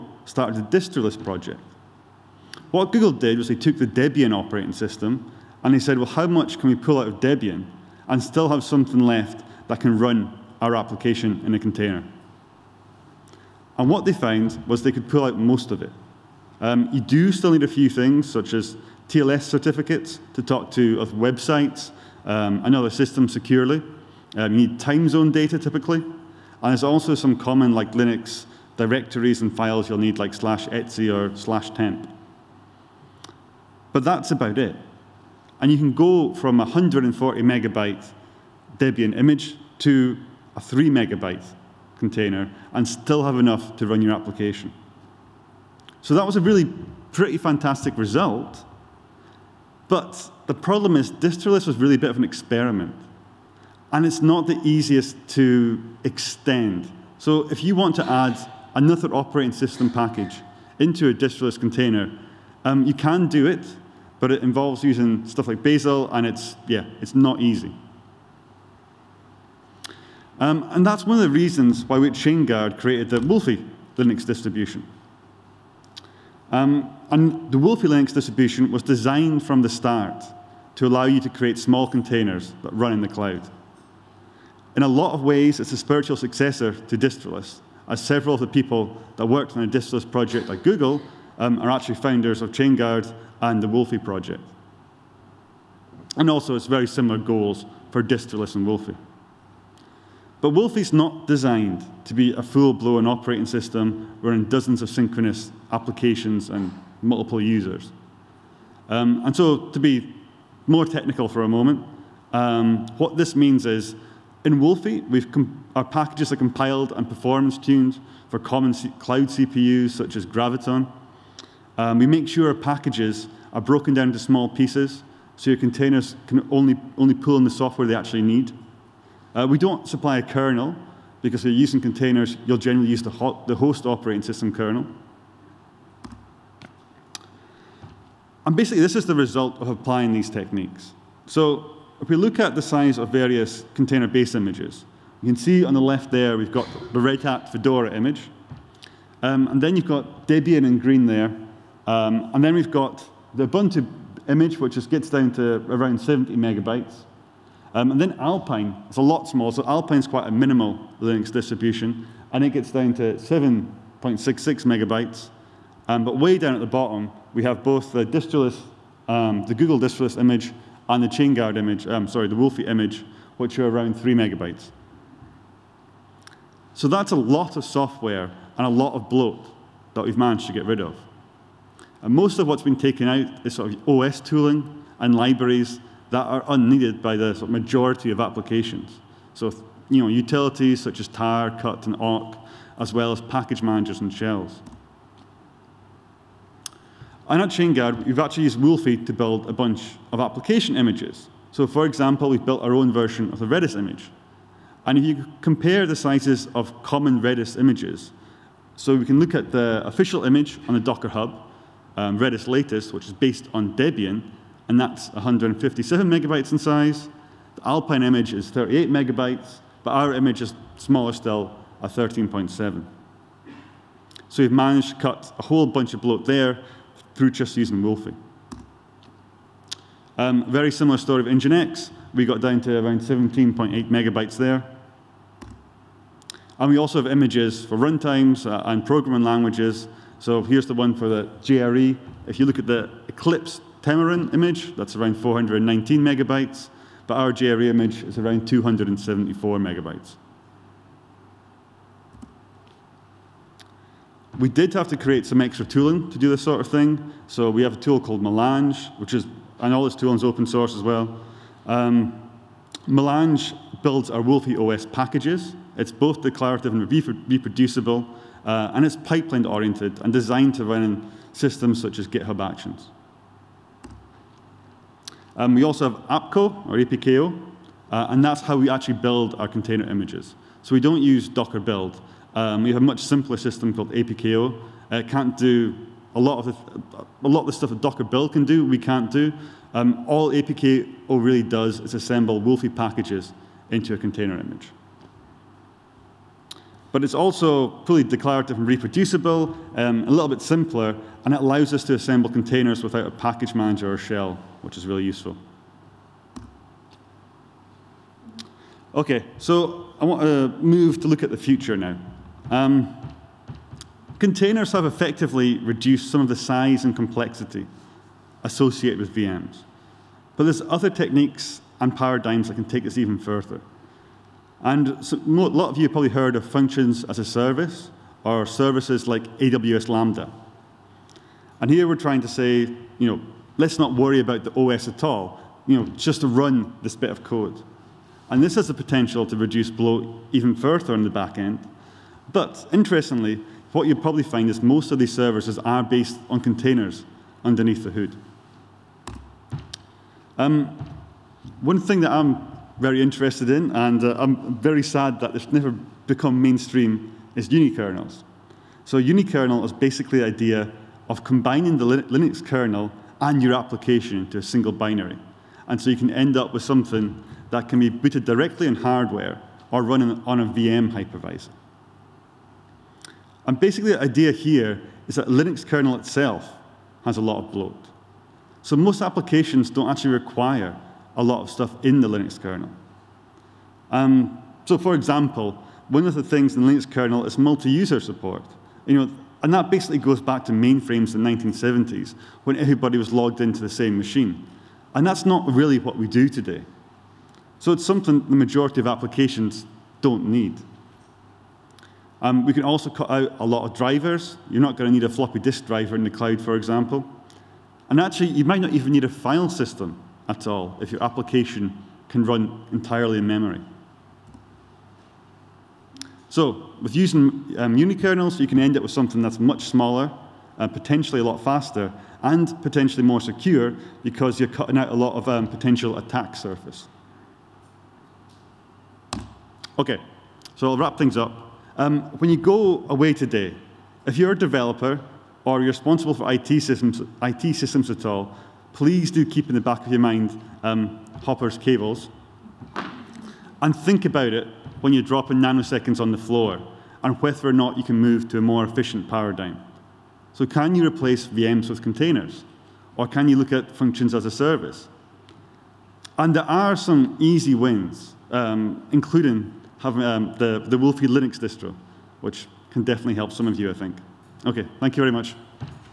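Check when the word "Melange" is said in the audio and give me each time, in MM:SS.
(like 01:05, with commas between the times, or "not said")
04:18, 04:22.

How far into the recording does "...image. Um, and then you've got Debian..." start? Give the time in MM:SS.
02:27.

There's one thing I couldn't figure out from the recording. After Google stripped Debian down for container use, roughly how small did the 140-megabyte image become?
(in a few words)
3 megabytes.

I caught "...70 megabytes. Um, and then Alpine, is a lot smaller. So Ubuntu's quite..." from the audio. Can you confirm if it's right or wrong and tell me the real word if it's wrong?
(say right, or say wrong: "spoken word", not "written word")
wrong: "Alpine", not "Ubuntu".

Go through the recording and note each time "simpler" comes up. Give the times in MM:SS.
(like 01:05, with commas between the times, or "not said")
04:42, 05:00.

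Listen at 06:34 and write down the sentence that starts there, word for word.
And that's not really what we do today.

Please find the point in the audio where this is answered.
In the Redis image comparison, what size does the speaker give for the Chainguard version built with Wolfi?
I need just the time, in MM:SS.
03:41.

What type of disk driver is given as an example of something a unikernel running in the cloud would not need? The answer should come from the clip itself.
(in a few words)
Floppy disk driver.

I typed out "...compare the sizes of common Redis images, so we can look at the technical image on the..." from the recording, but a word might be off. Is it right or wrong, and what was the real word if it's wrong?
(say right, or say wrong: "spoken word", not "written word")
wrong: "official", not "technical".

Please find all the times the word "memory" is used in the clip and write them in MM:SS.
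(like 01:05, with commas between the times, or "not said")
06:53.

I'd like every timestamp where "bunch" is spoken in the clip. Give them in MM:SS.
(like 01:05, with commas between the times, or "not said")
03:19, 03:45.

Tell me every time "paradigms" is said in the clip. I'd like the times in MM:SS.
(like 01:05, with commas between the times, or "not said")
05:21, 07:29.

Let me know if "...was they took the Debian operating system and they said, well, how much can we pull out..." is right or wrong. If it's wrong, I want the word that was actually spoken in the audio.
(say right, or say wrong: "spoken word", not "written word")
right.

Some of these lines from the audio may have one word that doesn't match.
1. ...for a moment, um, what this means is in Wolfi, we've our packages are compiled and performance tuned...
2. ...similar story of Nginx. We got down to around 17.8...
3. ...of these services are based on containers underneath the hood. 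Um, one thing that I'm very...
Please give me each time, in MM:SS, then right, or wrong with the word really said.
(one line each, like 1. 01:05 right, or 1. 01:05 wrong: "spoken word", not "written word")
1. 01:51 right
2. 03:50 right
3. 05:44 right.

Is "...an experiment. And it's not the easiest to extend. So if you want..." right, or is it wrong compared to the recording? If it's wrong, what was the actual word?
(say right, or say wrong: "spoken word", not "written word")
right.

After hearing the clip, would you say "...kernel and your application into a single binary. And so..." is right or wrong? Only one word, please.
right.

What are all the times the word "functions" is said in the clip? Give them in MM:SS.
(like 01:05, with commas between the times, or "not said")
05:26, 07:33.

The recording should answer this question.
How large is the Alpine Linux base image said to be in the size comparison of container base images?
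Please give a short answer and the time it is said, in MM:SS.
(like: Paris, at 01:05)
7.66 megabytes, at 02:43.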